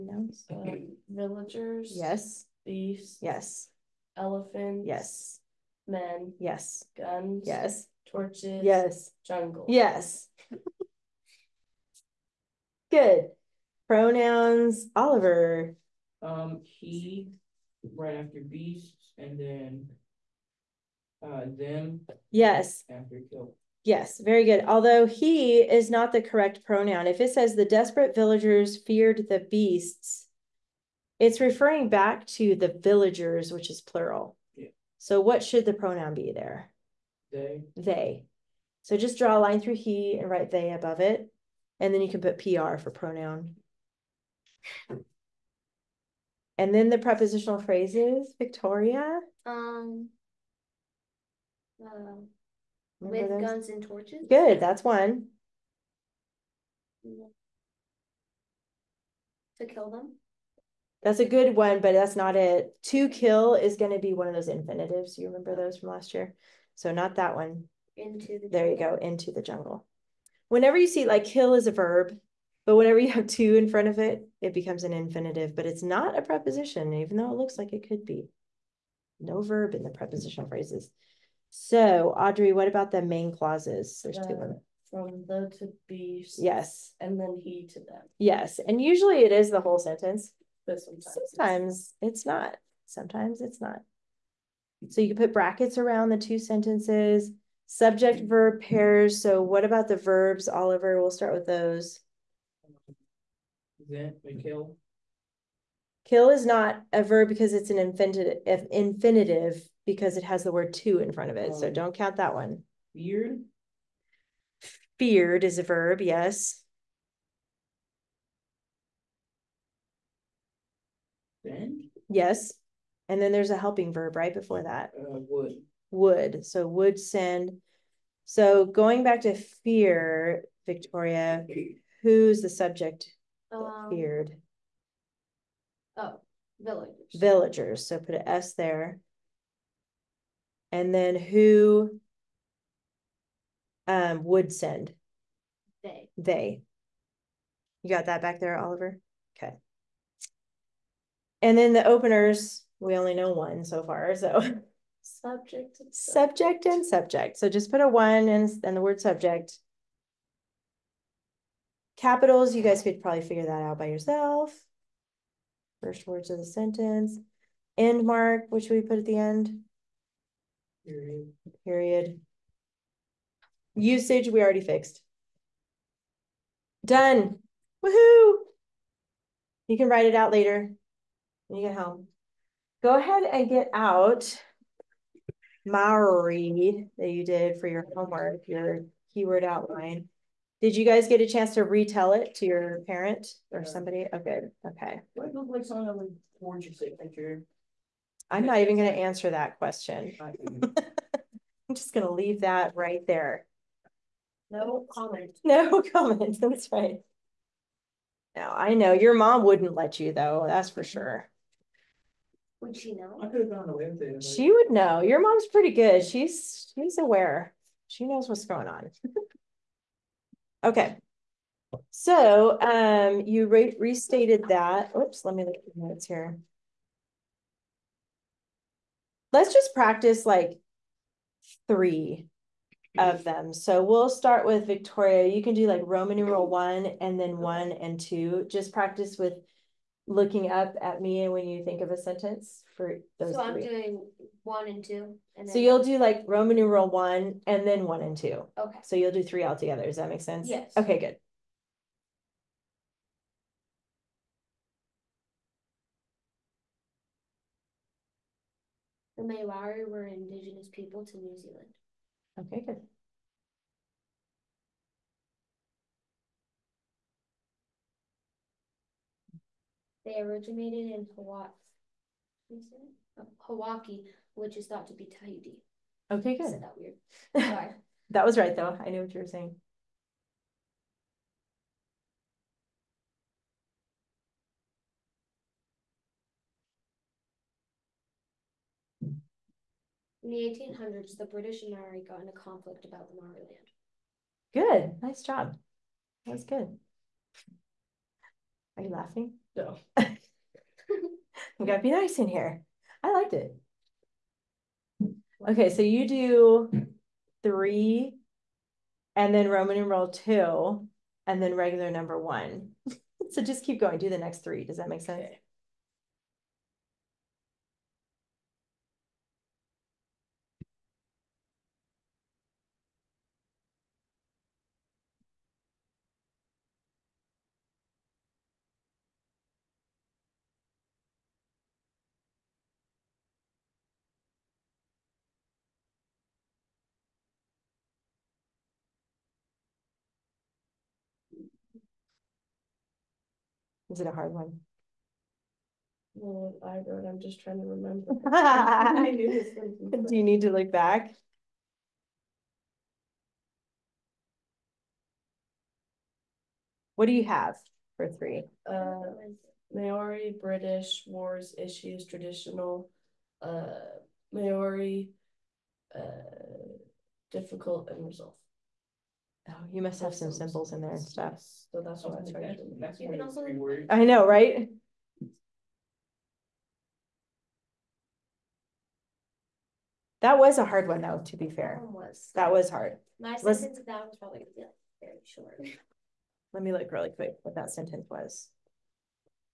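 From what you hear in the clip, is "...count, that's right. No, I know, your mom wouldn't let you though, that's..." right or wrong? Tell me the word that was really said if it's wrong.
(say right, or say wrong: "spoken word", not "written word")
wrong: "comment", not "count".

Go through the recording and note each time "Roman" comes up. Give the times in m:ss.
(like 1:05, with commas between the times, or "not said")
3:55, 4:06, 5:09.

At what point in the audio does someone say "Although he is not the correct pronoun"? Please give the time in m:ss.
0:24.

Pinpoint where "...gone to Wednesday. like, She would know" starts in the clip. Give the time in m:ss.
3:33.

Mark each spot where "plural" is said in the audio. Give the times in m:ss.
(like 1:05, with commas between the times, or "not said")
0:33.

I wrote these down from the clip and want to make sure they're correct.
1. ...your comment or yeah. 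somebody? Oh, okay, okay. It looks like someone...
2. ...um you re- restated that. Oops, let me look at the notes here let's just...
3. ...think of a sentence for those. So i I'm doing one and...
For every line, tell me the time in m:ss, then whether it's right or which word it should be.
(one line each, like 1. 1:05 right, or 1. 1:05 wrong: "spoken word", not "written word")
1. 3:12 wrong: "parent", not "comment"
2. 3:42 right
3. 4:01 right.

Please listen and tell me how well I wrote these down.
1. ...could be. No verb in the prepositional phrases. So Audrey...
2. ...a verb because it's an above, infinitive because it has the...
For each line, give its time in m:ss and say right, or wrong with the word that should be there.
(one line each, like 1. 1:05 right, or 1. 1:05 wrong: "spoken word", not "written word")
1. 1:17 right
2. 1:46 wrong: "infinitive", not "above".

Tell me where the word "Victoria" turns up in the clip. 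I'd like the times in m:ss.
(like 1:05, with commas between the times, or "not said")
0:48, 2:10, 3:54.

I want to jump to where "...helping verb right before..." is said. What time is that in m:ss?
2:03.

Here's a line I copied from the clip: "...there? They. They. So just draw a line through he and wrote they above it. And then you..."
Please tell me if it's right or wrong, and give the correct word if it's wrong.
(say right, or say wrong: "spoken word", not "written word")
wrong: "write", not "wrote".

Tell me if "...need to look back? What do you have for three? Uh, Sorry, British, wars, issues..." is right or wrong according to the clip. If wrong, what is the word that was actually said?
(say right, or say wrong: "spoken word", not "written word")
wrong: "Maori", not "Sorry".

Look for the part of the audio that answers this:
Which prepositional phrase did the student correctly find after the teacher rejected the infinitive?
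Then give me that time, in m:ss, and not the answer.
1:09.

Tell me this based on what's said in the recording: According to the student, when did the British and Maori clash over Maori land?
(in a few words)
1800s.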